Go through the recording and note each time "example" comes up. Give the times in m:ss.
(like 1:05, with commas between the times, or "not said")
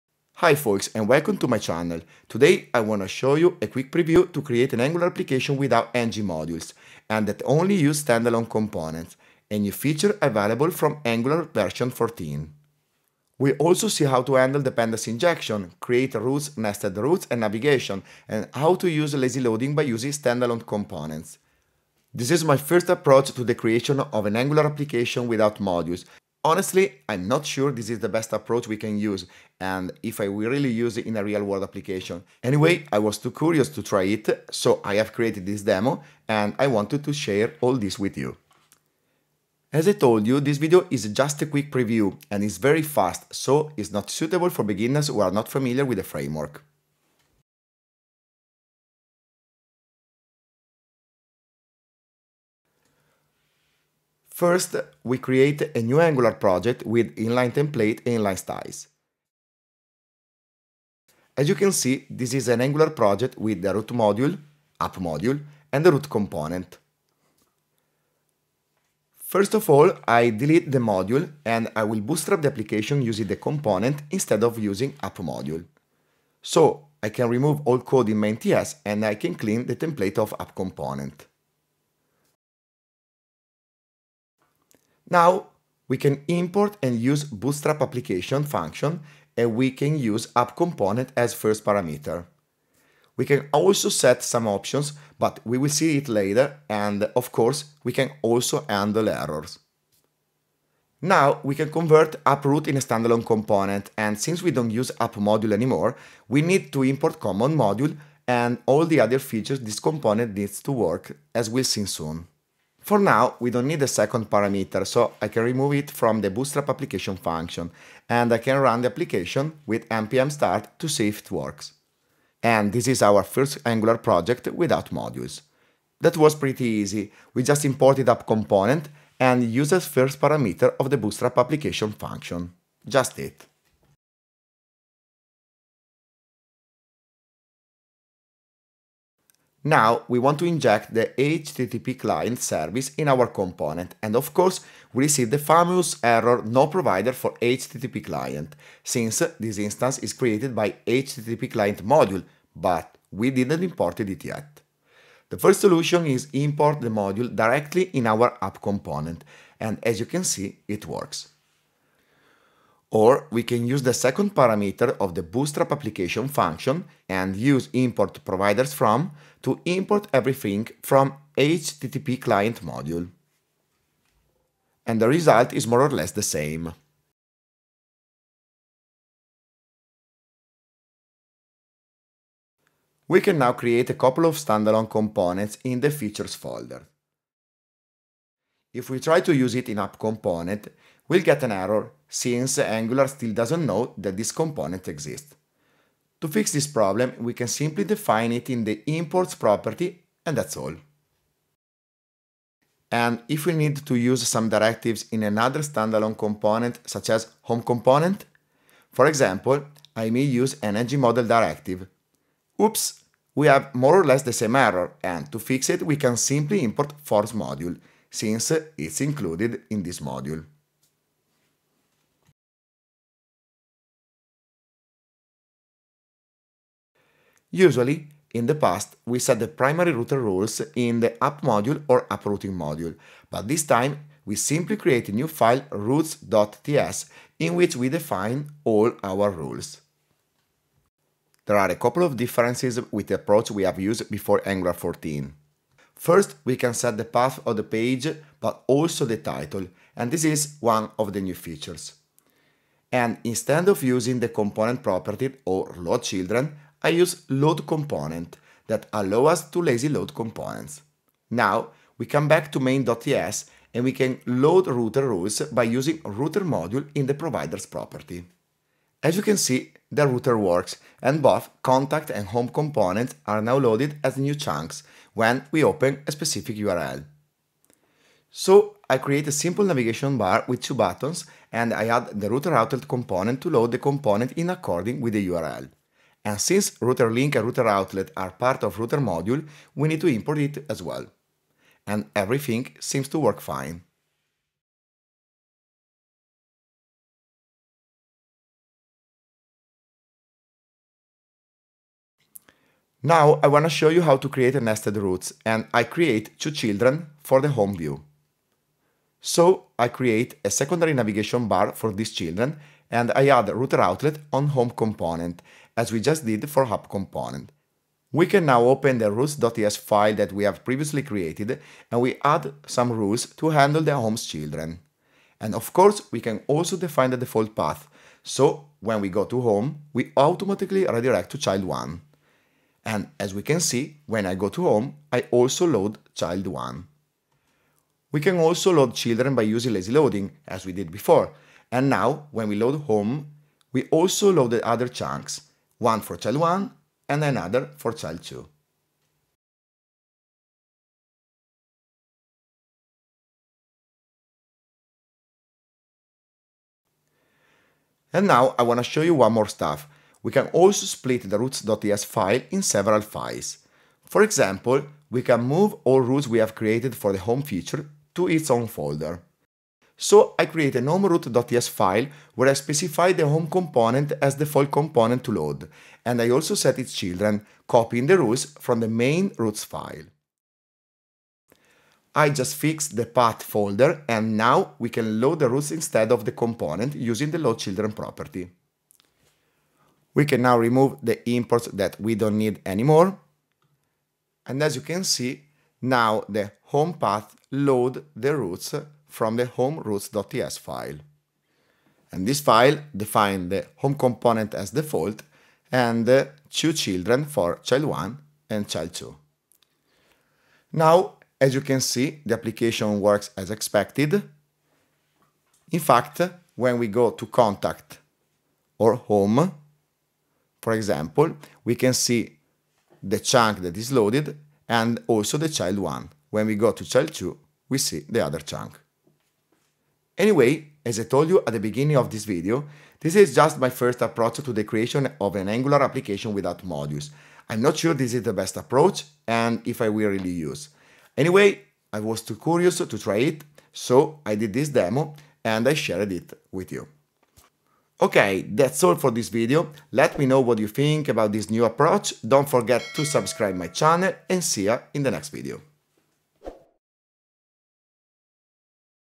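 3:29, 6:04, 7:00.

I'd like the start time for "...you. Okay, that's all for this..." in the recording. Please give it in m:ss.
7:26.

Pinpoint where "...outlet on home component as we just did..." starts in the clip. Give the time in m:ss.
5:13.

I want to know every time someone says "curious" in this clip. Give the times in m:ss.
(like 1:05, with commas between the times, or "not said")
0:33, 7:22.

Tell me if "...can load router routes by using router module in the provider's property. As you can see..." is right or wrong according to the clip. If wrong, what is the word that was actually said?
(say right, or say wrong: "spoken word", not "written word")
wrong: "rules", not "routes".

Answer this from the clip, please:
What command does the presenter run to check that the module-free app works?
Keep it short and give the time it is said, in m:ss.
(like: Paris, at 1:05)
npm start, at 1:59.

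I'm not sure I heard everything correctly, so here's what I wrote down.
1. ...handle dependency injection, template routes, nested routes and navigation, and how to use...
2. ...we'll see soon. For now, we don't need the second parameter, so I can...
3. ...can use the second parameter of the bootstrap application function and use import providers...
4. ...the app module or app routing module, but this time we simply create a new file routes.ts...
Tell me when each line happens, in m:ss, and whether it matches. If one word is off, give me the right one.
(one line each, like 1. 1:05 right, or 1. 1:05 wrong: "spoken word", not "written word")
1. 0:14 wrong: "create", not "template"
2. 1:51 right
3. 2:43 right
4. 3:51 right.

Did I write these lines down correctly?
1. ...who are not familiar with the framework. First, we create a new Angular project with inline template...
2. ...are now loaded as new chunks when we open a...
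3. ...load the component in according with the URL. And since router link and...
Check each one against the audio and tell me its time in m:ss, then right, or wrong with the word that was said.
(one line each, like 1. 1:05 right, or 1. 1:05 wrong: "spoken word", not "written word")
1. 0:45 right
2. 4:33 right
3. 4:43 right.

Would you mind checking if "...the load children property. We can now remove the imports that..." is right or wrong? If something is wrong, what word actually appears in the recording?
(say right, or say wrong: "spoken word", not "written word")
right.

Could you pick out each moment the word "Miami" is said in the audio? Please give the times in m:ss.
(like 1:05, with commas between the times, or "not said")
not said.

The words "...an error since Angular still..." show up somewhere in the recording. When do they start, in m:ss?
3:11.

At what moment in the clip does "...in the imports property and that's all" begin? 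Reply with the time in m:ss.
3:18.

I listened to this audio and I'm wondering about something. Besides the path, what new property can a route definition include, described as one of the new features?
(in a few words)
title.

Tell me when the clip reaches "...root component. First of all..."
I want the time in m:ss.
1:05.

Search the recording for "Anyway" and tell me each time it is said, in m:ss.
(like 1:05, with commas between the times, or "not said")
0:32, 7:10, 7:21.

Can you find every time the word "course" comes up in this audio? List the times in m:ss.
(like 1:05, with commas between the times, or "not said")
1:37, 2:24, 5:25.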